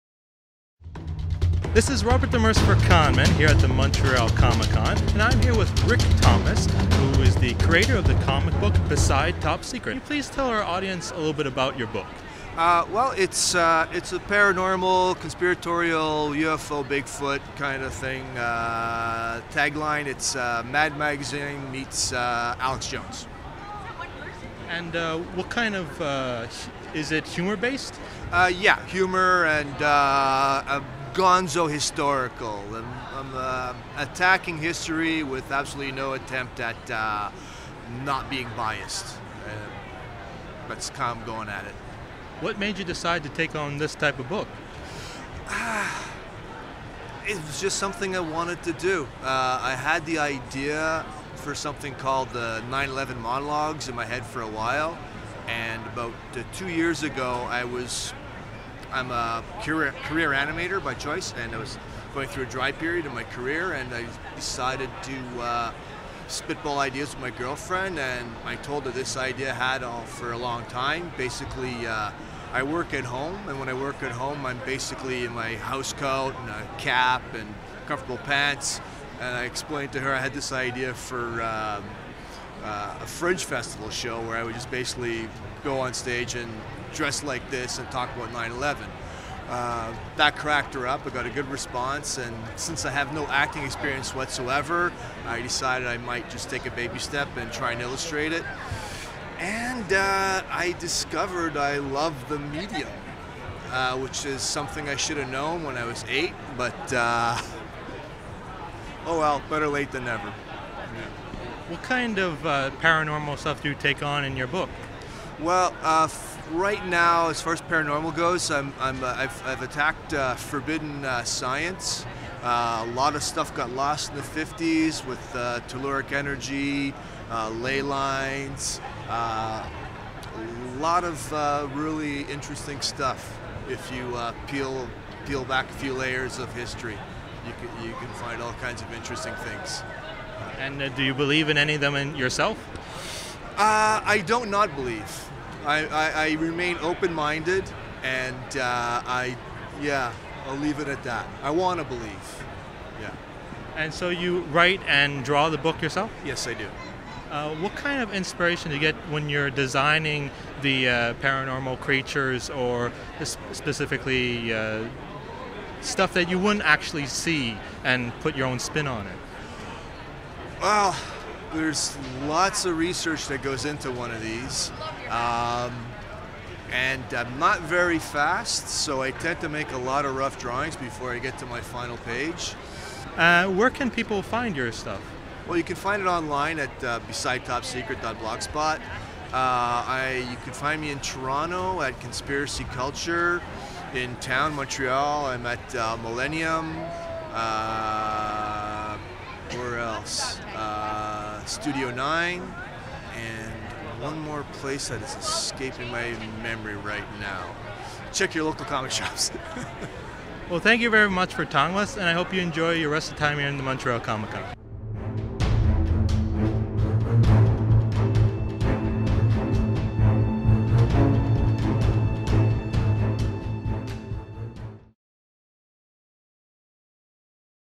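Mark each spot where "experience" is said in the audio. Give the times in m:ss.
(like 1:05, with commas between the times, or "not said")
1:33.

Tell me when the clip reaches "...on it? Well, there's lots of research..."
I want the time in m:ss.
2:48.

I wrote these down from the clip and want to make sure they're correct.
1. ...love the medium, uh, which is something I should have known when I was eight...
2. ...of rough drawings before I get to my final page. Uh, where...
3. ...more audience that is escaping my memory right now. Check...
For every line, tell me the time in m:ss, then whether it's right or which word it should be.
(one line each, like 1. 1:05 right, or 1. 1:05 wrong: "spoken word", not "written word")
1. 1:41 right
2. 3:00 right
3. 3:24 wrong: "place", not "audience".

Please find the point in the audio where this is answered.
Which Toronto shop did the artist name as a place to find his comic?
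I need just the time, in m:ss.
3:12.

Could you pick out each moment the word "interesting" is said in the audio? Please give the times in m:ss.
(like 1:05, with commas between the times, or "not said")
2:12, 2:18.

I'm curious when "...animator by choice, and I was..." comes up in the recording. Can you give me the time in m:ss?
1:00.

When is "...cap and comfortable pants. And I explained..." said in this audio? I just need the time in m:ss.
1:16.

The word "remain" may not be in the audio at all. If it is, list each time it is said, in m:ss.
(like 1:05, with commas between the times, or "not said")
2:26.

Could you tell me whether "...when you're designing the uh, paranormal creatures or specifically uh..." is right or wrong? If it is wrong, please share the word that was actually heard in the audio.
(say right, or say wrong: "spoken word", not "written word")
right.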